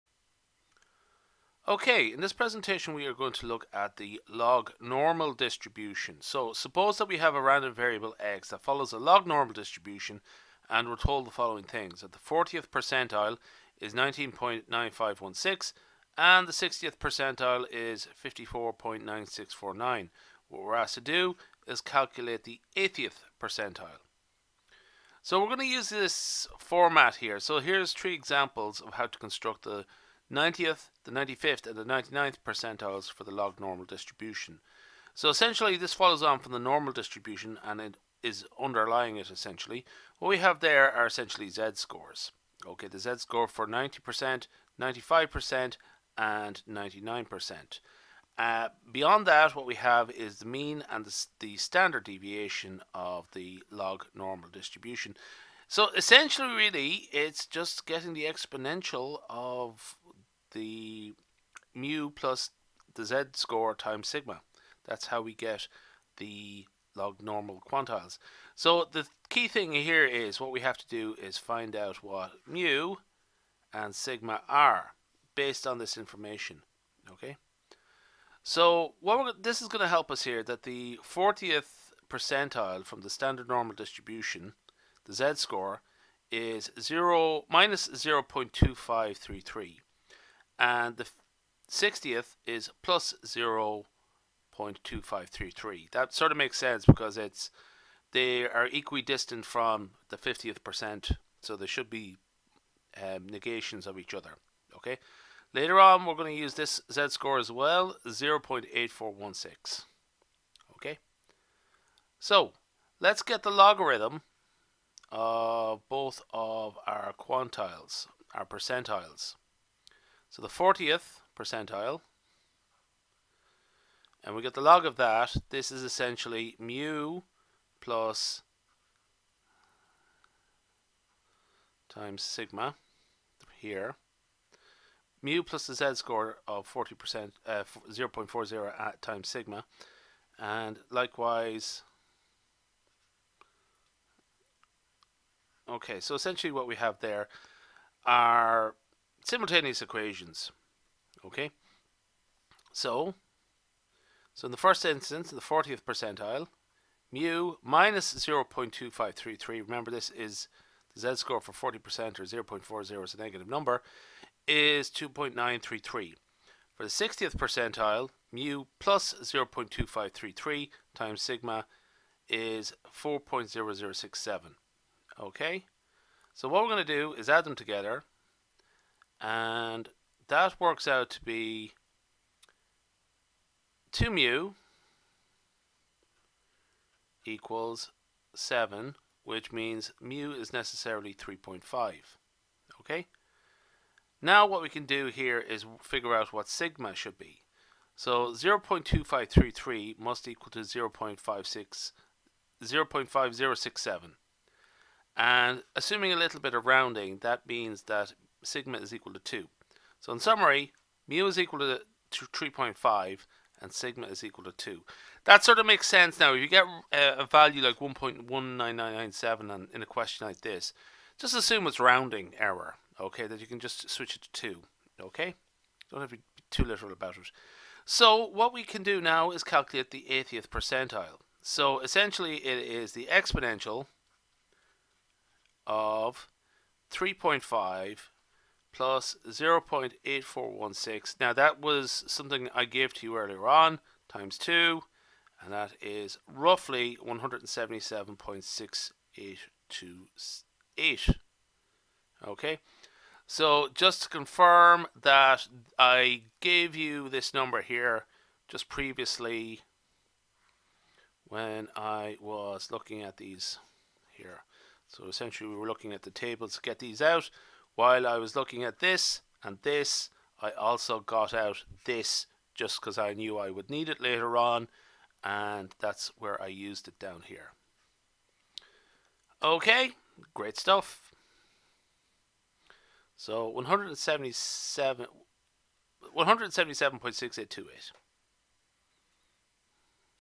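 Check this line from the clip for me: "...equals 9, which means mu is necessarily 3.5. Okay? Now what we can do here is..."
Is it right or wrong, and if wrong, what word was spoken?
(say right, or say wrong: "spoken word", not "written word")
wrong: "7", not "9".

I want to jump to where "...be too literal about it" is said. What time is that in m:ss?
3:46.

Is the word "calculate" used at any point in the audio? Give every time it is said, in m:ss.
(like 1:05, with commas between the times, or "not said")
0:21, 3:49.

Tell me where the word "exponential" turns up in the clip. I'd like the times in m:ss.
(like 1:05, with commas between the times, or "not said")
0:58, 3:53.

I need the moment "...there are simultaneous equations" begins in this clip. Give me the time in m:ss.
2:27.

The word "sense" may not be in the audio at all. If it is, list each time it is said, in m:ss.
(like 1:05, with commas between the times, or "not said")
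1:36, 3:35.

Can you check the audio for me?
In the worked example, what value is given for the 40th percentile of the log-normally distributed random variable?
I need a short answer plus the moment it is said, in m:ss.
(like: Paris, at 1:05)
19.9516, at 0:13.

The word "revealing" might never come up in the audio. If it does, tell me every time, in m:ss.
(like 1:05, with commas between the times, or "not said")
not said.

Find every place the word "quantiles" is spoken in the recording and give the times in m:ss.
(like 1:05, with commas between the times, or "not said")
1:07, 1:57.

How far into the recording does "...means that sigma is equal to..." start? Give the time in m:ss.
3:27.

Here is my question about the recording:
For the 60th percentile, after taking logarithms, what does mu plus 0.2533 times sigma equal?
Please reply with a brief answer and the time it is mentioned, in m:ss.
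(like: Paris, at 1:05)
4.0067, at 2:52.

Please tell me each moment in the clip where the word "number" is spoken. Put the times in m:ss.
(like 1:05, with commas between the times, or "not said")
2:43, 4:17.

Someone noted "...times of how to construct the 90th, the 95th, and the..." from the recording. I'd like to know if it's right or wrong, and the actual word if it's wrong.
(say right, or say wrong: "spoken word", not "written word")
wrong: "examples", not "times".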